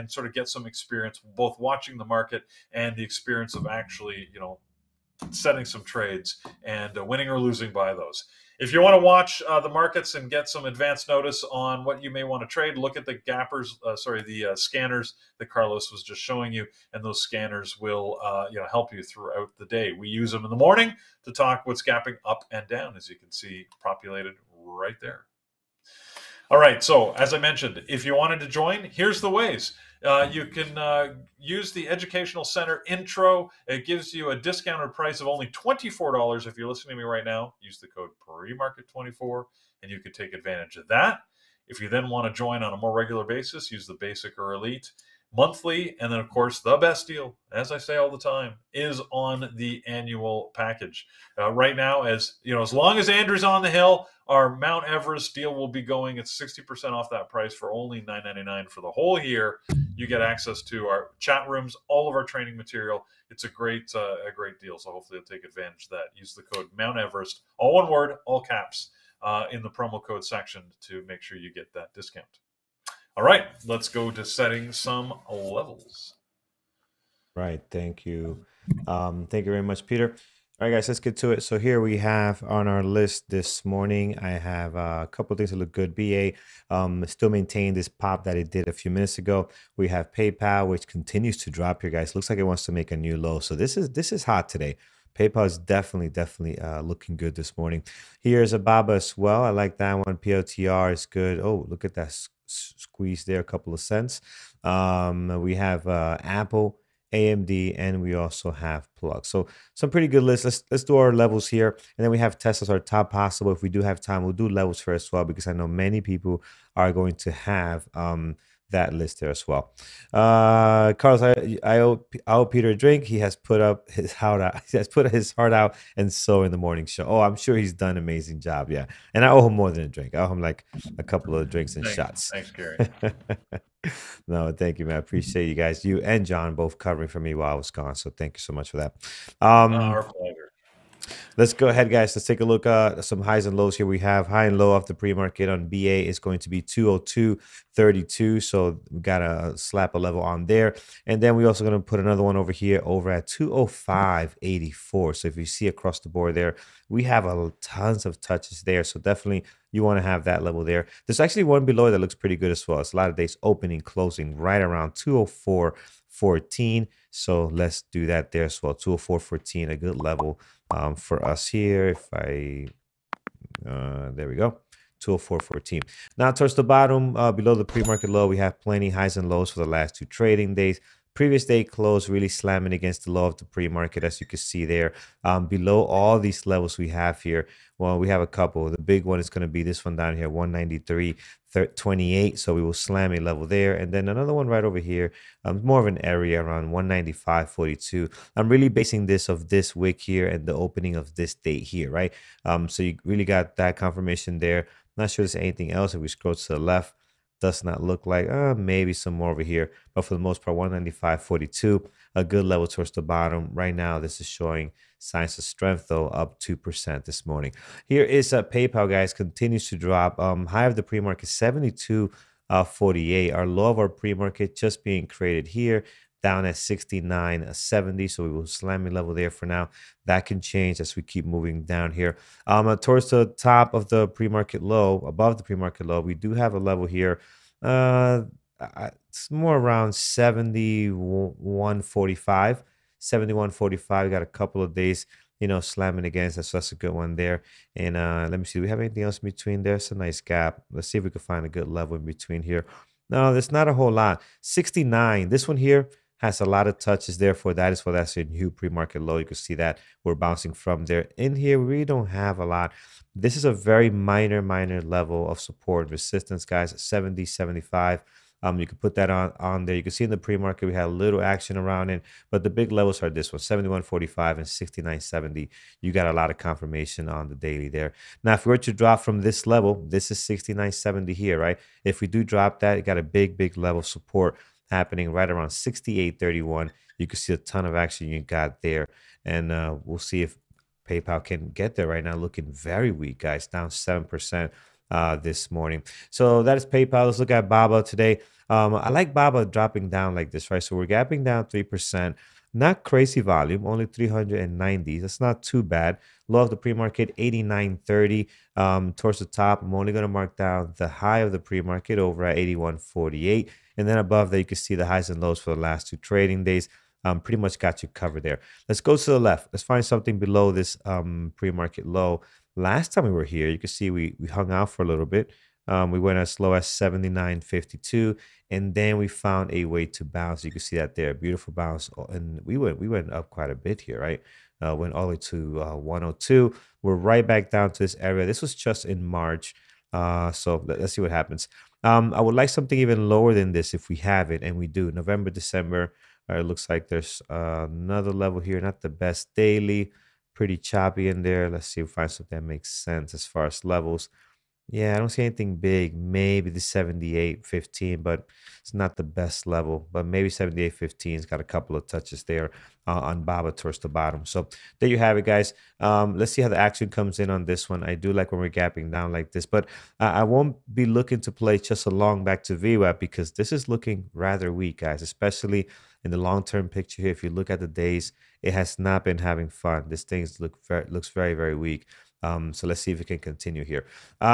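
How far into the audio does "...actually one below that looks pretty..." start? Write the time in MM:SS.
02:41.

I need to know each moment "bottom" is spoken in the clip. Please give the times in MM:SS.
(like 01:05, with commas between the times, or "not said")
02:56, 03:33, 06:03.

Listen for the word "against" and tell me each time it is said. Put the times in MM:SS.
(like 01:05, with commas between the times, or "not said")
03:02, 04:06.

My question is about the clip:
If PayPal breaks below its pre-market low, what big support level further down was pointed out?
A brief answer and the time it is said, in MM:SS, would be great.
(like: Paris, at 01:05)
68.31, at 04:45.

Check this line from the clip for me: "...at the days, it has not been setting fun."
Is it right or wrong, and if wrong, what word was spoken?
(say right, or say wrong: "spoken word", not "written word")
wrong: "having", not "setting".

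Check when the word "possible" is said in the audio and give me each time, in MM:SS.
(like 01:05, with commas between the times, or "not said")
01:53.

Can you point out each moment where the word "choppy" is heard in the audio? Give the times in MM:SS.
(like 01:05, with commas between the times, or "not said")
05:50.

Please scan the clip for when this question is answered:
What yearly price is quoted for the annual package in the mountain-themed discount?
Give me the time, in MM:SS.
00:58.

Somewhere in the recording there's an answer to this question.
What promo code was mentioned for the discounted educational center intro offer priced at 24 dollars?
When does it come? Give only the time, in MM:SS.
00:38.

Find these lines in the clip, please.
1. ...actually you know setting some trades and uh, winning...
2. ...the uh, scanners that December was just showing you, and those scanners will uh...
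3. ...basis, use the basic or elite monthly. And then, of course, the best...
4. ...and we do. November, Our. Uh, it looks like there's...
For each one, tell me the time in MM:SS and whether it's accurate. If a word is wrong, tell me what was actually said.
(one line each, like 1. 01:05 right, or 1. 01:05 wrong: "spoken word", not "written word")
1. 00:03 right
2. 00:14 wrong: "Carlos", not "December"
3. 00:43 right
4. 05:44 wrong: "December", not "Our".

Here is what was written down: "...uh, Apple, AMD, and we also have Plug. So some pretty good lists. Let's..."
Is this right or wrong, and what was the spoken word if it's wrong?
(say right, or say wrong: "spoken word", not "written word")
right.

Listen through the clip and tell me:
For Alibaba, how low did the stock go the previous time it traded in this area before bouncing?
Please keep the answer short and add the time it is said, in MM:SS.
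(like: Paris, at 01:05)
79.52, at 05:26.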